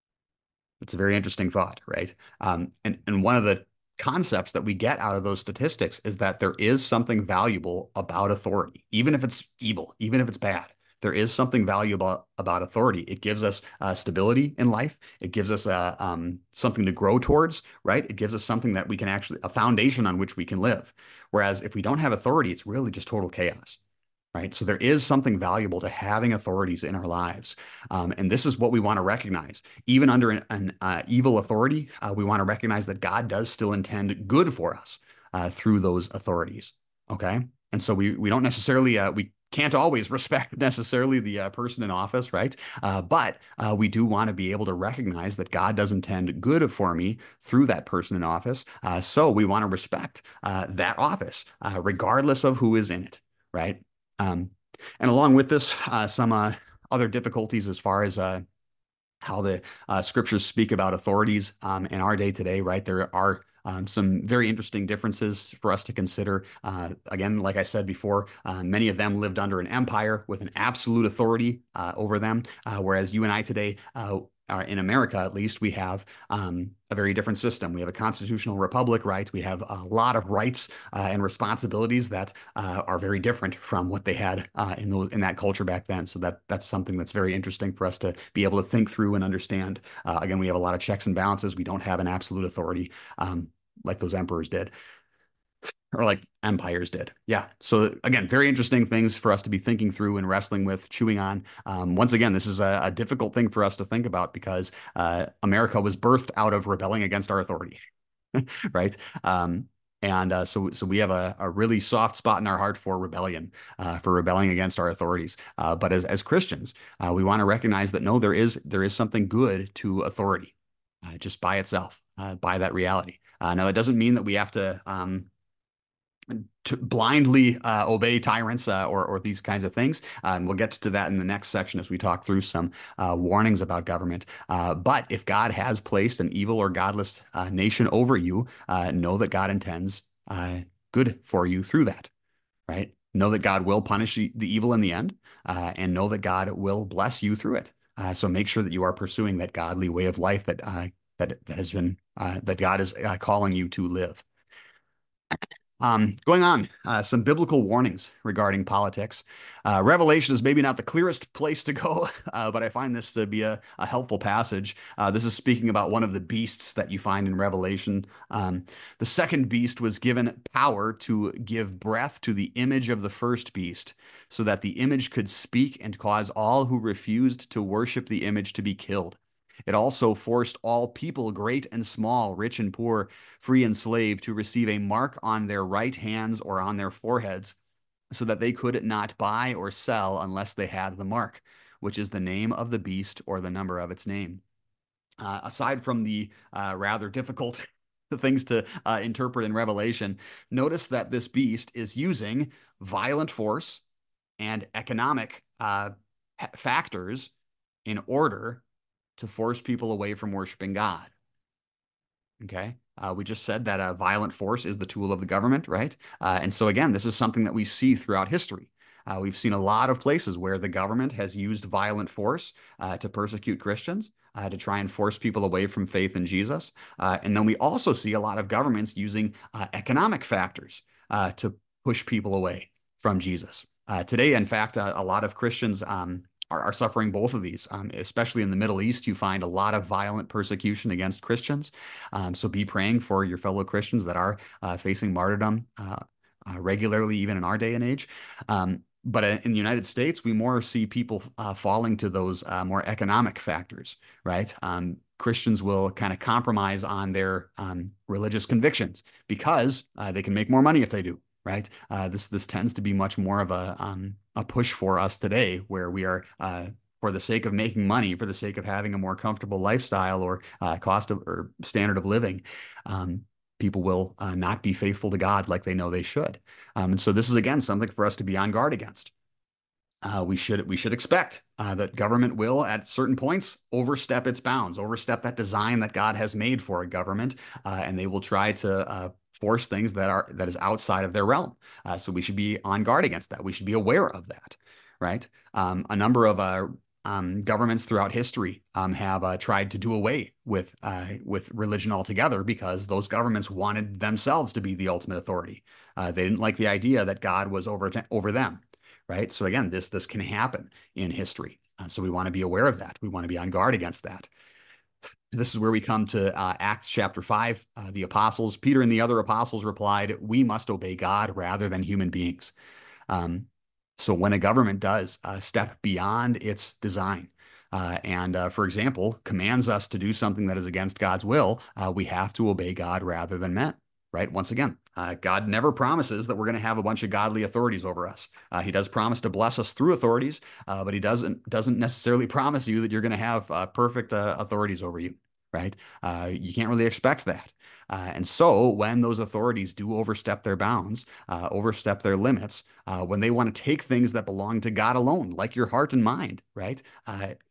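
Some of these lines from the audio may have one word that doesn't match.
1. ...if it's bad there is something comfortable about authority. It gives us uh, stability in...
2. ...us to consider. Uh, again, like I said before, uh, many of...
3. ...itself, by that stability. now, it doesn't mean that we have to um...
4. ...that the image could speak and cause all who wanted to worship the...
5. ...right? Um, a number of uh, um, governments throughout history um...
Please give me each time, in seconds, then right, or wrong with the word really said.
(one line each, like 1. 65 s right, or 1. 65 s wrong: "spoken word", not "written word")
1. 10 s wrong: "valuable", not "comfortable"
2. 65 s right
3. 121 s wrong: "reality", not "stability"
4. 174 s wrong: "refused", not "wanted"
5. 294 s right.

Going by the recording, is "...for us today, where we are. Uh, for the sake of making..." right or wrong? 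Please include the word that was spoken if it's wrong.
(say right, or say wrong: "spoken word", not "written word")
right.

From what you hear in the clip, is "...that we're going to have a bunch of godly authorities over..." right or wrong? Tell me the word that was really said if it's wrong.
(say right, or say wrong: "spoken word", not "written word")
right.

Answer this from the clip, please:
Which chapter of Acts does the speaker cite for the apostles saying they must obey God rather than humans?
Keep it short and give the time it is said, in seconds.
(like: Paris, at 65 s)
Chapter 5, at 316 s.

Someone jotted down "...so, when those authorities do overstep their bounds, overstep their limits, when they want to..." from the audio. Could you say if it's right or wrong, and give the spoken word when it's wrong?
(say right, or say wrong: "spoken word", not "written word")
right.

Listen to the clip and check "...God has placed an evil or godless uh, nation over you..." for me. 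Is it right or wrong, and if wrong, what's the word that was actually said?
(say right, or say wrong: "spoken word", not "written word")
right.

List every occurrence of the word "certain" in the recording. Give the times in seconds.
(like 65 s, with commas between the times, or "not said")
282 s.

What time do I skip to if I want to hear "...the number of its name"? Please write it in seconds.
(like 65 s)
193 s.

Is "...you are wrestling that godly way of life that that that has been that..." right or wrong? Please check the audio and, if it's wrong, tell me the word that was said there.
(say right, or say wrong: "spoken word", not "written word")
wrong: "pursuing", not "wrestling".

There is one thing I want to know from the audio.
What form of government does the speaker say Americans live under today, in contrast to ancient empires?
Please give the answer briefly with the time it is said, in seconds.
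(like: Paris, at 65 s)
Constitutional republic, at 77 s.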